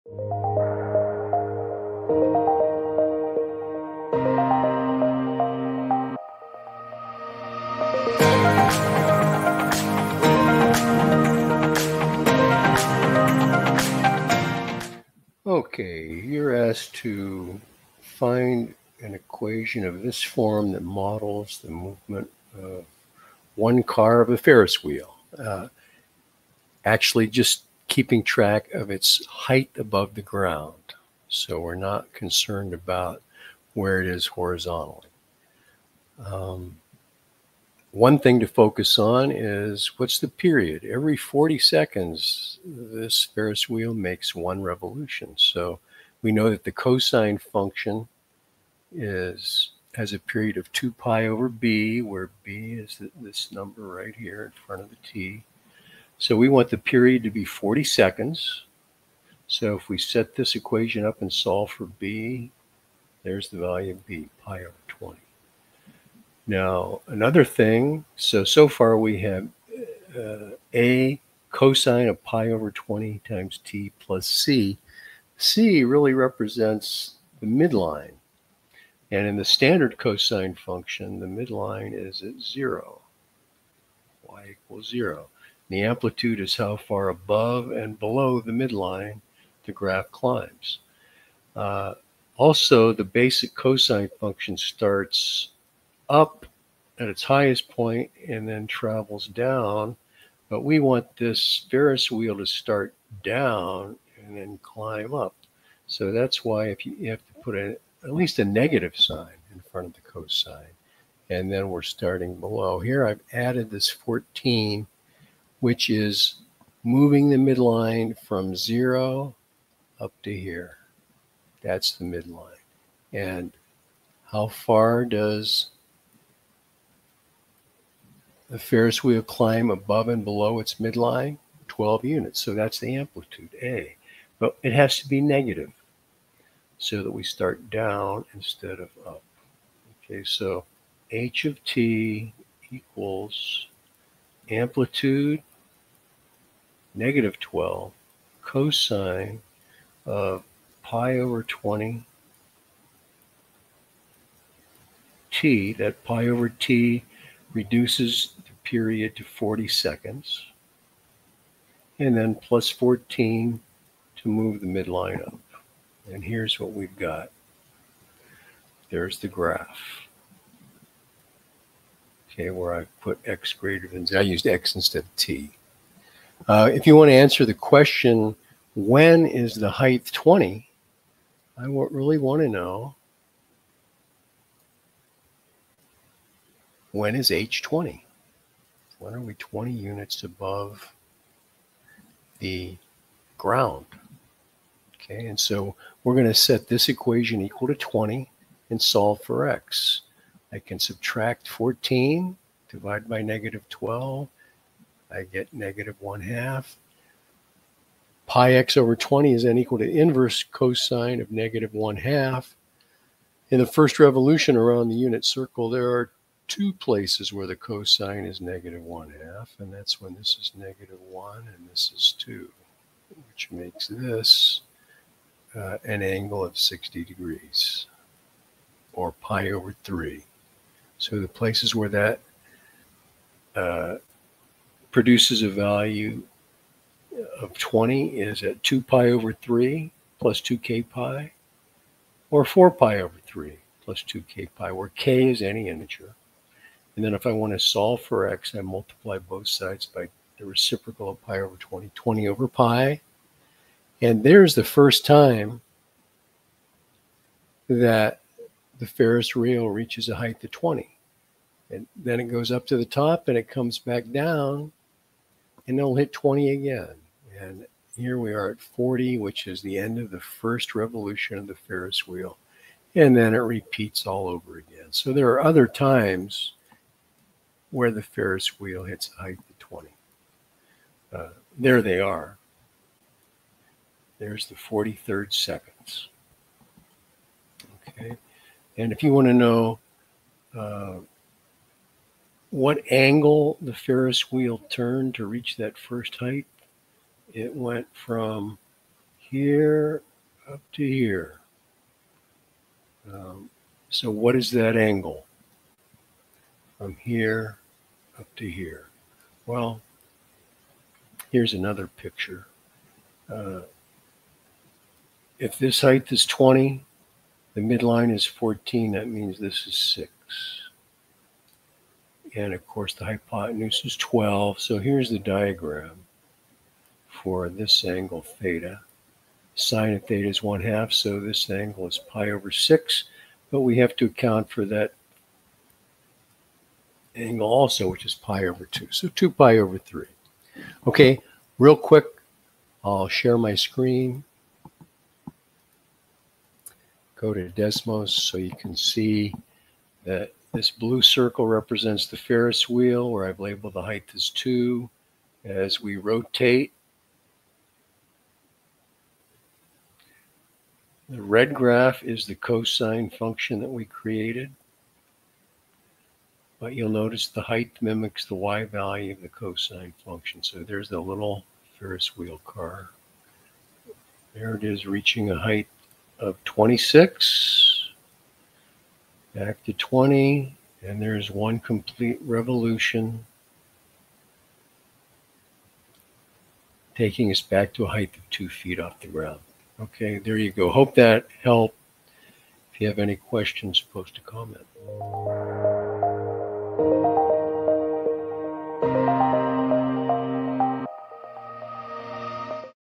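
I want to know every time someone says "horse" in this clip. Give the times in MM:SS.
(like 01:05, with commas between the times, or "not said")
not said.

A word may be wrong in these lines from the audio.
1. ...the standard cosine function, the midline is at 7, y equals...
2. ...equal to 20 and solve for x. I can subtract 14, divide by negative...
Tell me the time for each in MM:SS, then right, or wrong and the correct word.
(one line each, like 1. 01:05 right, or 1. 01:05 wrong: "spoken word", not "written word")
1. 01:19 wrong: "0", not "7"
2. 03:17 right.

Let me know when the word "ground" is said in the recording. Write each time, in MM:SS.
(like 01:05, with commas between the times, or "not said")
00:30, 03:13, 06:29.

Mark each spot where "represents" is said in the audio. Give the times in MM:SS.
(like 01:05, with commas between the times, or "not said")
01:16, 05:51.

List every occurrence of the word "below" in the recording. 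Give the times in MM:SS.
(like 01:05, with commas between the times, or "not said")
01:27, 01:52, 02:10.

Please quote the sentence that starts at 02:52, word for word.
Okay, where I put x greater than z.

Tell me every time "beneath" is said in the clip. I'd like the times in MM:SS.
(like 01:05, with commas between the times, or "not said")
not said.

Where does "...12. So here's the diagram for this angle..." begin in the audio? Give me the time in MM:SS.
05:23.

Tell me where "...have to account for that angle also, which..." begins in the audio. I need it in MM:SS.
05:33.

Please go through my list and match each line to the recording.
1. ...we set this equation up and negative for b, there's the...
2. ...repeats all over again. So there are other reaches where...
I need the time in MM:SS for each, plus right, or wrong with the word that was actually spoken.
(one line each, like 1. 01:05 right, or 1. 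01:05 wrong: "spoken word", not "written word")
1. 00:59 wrong: "solve", not "negative"
2. 04:33 wrong: "times", not "reaches".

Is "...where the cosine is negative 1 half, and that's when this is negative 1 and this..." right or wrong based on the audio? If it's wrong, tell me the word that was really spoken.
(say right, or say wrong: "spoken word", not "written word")
right.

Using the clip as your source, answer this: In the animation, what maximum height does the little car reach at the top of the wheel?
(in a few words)
26.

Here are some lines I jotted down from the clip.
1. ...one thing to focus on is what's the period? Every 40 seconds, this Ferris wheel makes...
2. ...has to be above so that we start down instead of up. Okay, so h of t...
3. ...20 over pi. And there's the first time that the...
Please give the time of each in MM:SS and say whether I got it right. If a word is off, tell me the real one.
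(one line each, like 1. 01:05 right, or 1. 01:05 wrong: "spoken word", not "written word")
1. 00:37 right
2. 02:14 wrong: "negative", not "above"
3. 04:11 right.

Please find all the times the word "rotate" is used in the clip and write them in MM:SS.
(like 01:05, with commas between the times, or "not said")
05:55.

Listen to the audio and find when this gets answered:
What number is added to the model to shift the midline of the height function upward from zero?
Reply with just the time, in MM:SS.
01:53.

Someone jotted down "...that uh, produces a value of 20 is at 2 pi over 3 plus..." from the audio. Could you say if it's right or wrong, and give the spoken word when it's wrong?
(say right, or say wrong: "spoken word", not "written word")
right.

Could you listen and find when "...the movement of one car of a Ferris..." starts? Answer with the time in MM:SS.
00:21.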